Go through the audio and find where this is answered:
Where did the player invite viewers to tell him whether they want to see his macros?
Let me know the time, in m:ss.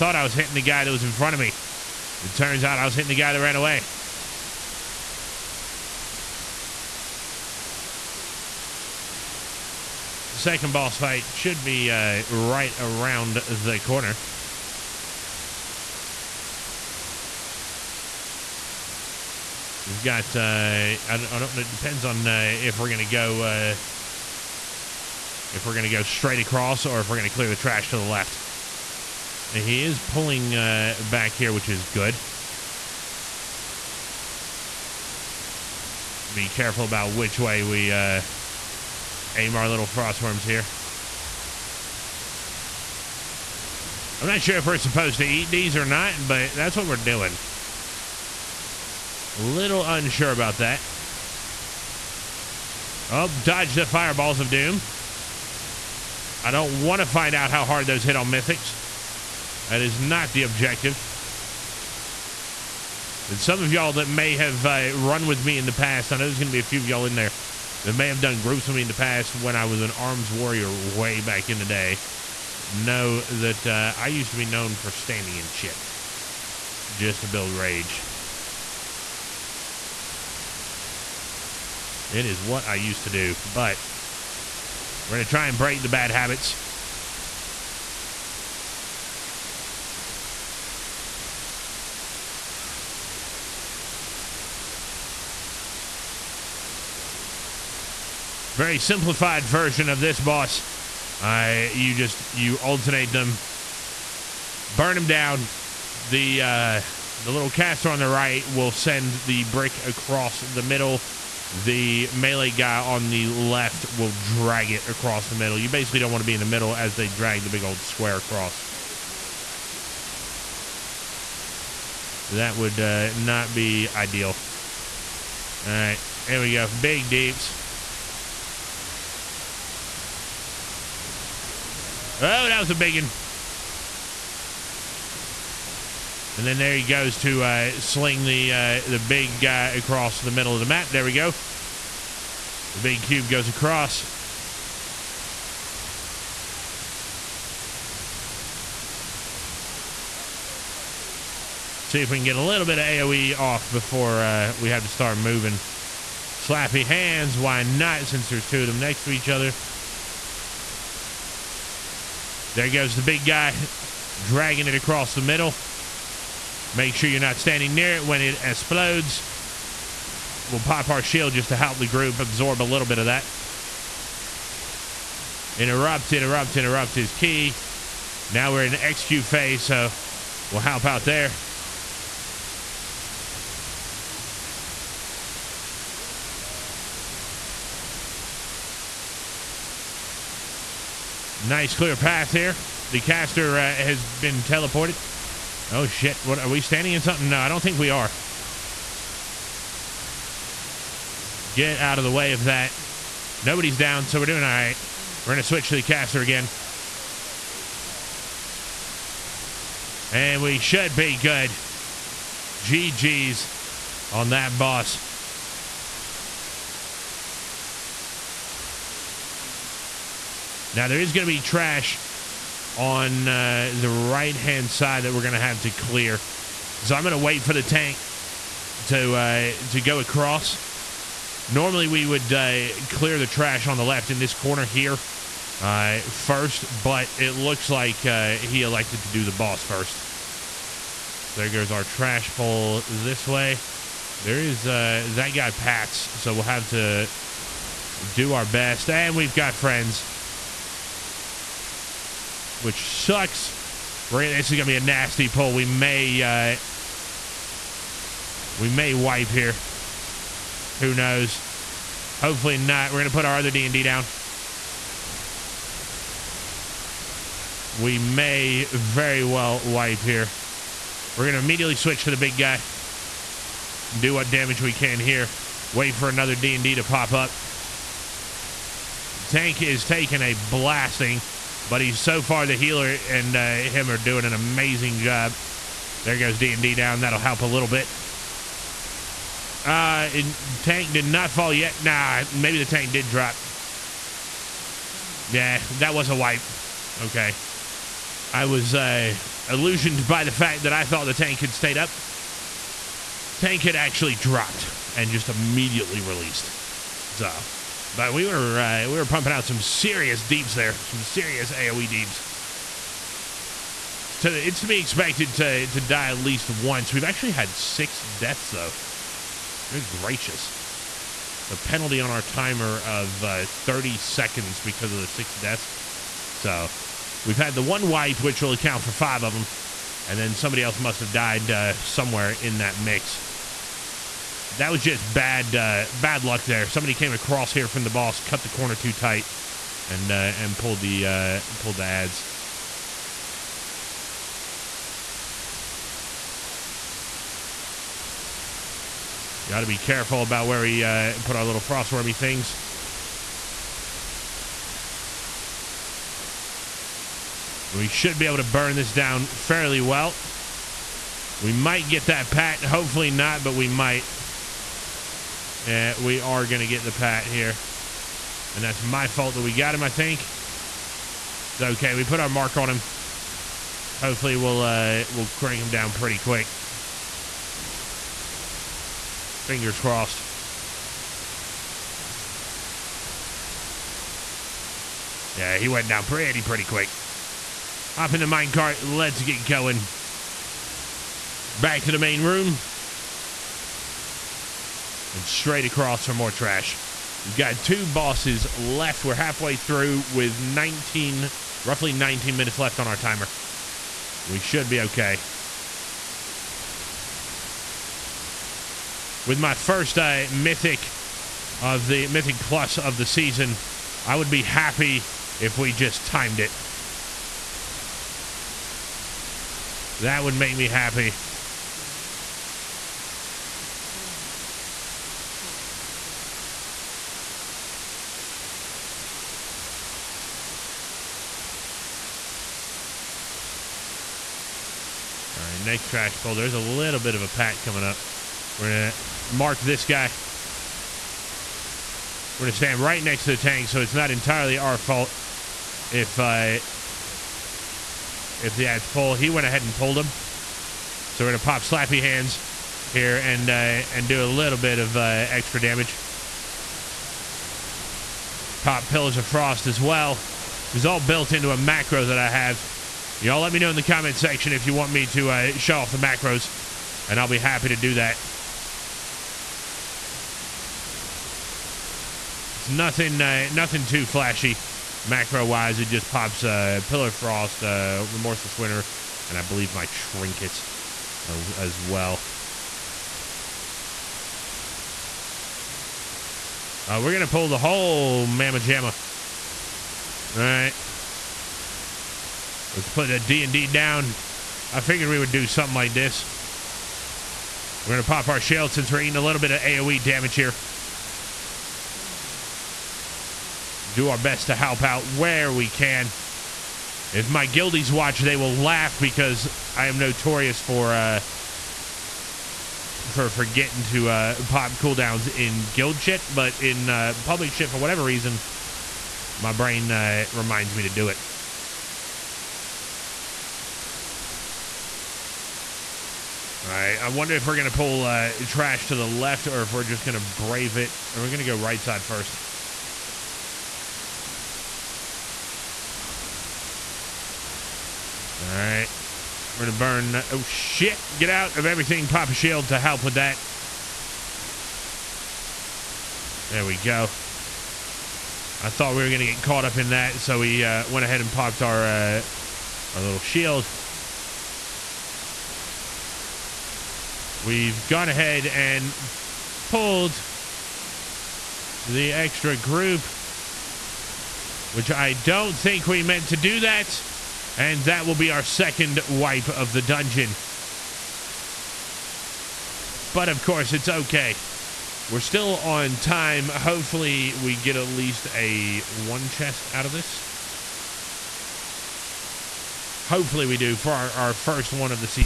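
7:43.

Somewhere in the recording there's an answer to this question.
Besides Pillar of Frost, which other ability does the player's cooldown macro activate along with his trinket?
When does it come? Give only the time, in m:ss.
7:58.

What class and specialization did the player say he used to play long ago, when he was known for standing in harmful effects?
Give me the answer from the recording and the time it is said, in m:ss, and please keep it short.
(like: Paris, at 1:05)
Arms warrior, at 1:09.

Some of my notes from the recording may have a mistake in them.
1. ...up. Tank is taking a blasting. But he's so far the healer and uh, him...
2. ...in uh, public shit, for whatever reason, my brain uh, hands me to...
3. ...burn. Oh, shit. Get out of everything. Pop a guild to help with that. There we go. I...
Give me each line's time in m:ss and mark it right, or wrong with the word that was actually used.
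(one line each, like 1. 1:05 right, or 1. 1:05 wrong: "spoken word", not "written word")
1. 4:37 right
2. 8:36 wrong: "reminds", not "hands"
3. 8:59 wrong: "shield", not "guild".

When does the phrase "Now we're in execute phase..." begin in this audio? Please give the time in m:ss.
2:58.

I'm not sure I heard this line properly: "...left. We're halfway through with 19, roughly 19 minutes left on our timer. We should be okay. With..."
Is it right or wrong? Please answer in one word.
right.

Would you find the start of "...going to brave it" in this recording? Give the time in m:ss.
8:50.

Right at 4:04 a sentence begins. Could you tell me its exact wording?
There is uh, that guy Pats, so we'll have to do our best.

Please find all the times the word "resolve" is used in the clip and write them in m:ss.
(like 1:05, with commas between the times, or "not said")
not said.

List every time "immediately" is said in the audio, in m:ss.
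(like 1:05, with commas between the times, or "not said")
4:31, 5:05.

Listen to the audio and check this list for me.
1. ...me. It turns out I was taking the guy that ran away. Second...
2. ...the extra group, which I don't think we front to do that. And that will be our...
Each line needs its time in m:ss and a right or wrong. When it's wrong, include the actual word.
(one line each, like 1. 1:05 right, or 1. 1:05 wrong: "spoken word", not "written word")
1. 0:01 wrong: "hitting", not "taking"
2. 9:21 wrong: "meant", not "front".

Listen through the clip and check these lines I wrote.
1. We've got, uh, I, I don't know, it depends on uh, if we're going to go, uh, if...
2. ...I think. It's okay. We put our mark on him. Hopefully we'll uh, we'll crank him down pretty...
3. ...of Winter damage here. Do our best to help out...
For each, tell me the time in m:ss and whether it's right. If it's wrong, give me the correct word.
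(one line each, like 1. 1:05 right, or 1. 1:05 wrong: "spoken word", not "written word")
1. 0:19 right
2. 6:09 right
3. 8:19 wrong: "AoE", not "Winter".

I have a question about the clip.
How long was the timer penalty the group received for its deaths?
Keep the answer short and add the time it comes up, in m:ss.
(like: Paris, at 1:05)
30 seconds, at 5:23.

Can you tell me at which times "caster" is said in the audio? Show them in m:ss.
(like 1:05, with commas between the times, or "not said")
1:47, 3:13, 3:25.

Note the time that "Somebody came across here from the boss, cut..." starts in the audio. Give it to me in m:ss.
5:36.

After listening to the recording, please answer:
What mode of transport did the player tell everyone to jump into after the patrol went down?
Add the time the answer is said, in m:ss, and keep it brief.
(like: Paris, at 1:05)
Minecart, at 6:28.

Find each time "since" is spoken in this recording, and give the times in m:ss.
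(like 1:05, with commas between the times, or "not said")
2:38, 8:18.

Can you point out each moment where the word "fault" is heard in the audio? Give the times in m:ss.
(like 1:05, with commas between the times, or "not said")
6:09, 7:24.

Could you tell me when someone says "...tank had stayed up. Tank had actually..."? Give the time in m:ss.
5:01.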